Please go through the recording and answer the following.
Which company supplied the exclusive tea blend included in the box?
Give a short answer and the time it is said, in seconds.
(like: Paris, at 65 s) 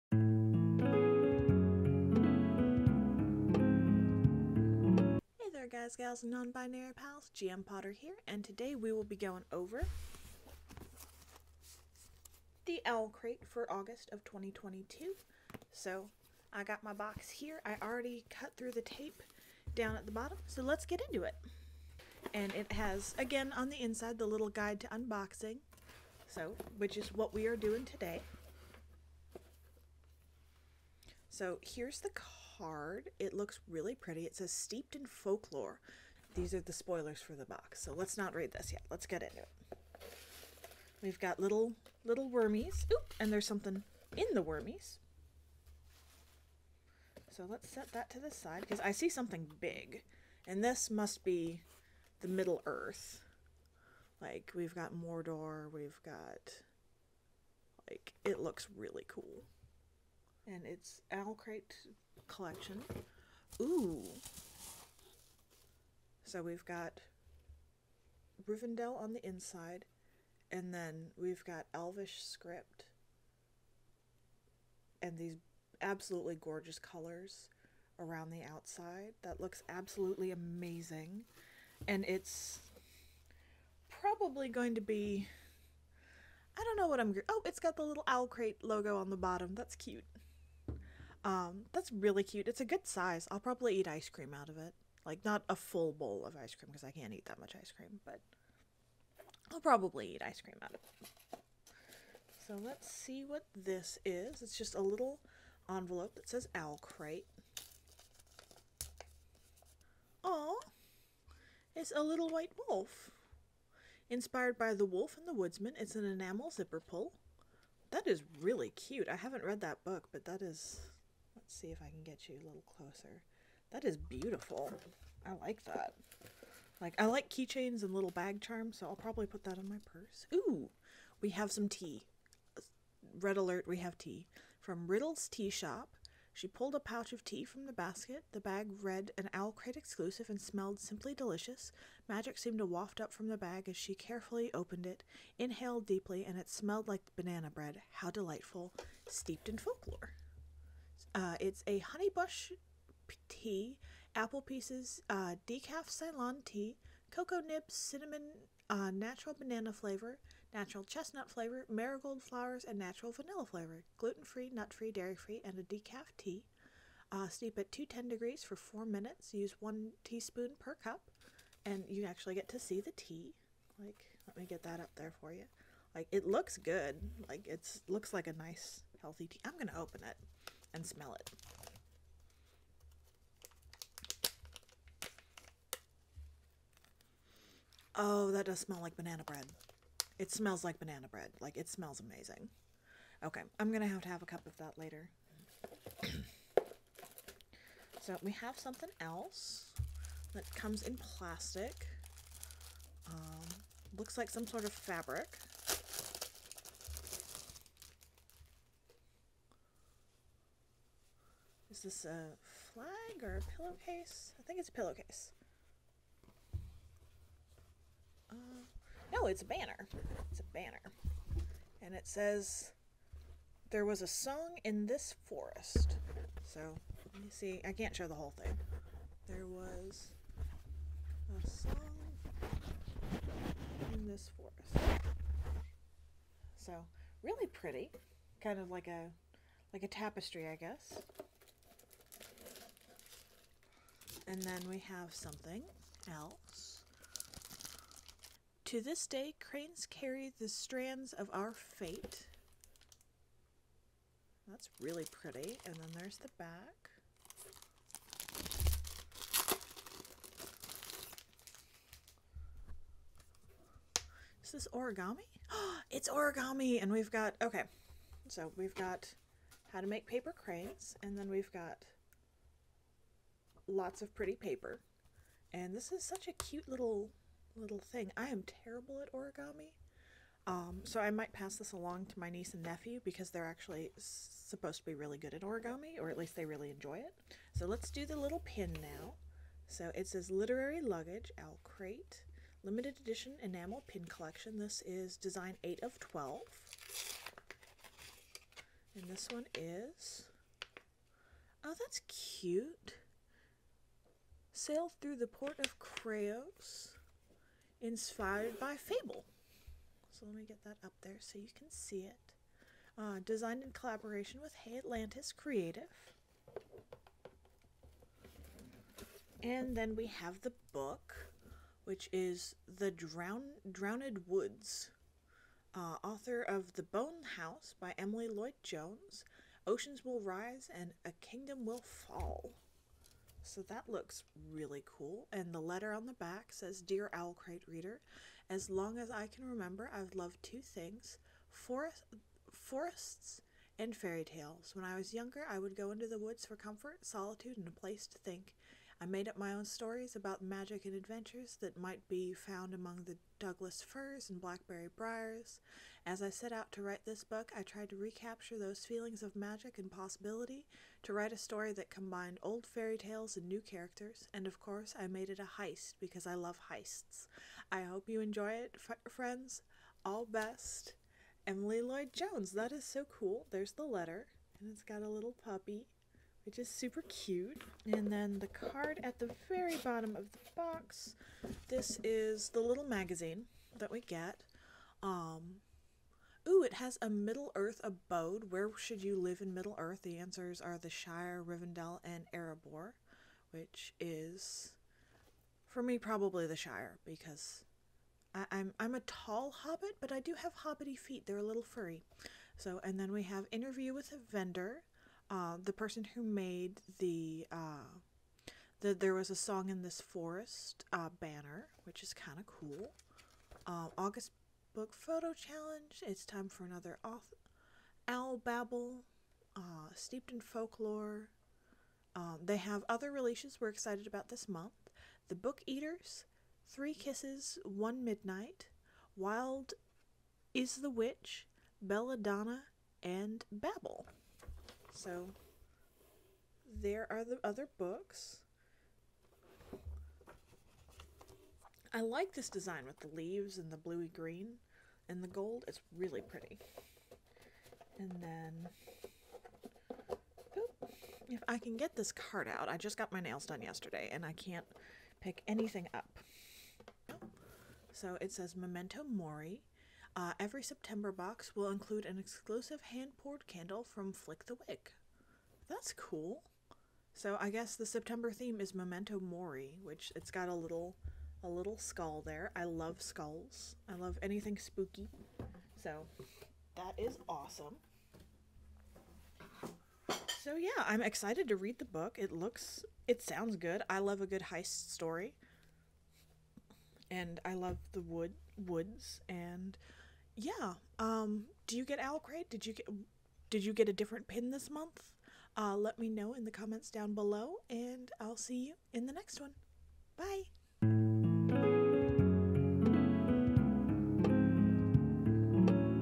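Riddle's Tea Shop, at 134 s.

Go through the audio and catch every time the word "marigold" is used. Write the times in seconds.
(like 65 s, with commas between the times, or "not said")
161 s.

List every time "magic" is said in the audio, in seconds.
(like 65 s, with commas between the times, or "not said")
142 s, 350 s, 359 s.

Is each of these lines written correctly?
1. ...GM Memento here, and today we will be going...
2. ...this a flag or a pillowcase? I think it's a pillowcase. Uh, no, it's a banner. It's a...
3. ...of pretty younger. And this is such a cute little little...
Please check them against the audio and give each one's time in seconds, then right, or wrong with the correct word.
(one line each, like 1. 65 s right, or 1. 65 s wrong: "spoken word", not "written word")
1. 7 s wrong: "Potter", not "Memento"
2. 211 s right
3. 274 s wrong: "paper", not "younger".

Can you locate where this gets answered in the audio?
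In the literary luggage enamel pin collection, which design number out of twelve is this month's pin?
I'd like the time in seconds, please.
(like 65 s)
295 s.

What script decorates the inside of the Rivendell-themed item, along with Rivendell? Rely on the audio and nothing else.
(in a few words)
Elvish script.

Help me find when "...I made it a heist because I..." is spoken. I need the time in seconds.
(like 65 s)
364 s.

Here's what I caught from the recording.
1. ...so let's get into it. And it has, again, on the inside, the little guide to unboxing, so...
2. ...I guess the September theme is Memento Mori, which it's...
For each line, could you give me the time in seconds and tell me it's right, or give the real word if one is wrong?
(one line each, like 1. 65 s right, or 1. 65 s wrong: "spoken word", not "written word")
1. 20 s right
2. 467 s right.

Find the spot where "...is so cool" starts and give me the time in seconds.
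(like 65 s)
372 s.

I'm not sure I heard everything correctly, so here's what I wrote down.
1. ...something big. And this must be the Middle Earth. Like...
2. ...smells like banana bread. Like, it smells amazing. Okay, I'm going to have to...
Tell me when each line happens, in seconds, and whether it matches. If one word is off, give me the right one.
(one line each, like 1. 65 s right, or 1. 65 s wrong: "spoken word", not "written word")
1. 49 s right
2. 190 s right.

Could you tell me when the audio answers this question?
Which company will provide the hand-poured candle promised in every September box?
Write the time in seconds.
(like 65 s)
464 s.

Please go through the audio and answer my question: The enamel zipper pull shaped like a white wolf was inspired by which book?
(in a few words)
The Wolf and the Woodsman.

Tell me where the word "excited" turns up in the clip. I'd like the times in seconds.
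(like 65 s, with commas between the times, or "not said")
423 s, 481 s.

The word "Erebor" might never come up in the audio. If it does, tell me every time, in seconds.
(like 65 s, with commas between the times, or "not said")
392 s.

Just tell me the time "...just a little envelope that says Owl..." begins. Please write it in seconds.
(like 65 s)
104 s.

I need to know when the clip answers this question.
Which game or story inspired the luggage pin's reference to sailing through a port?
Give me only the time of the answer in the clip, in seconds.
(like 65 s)
308 s.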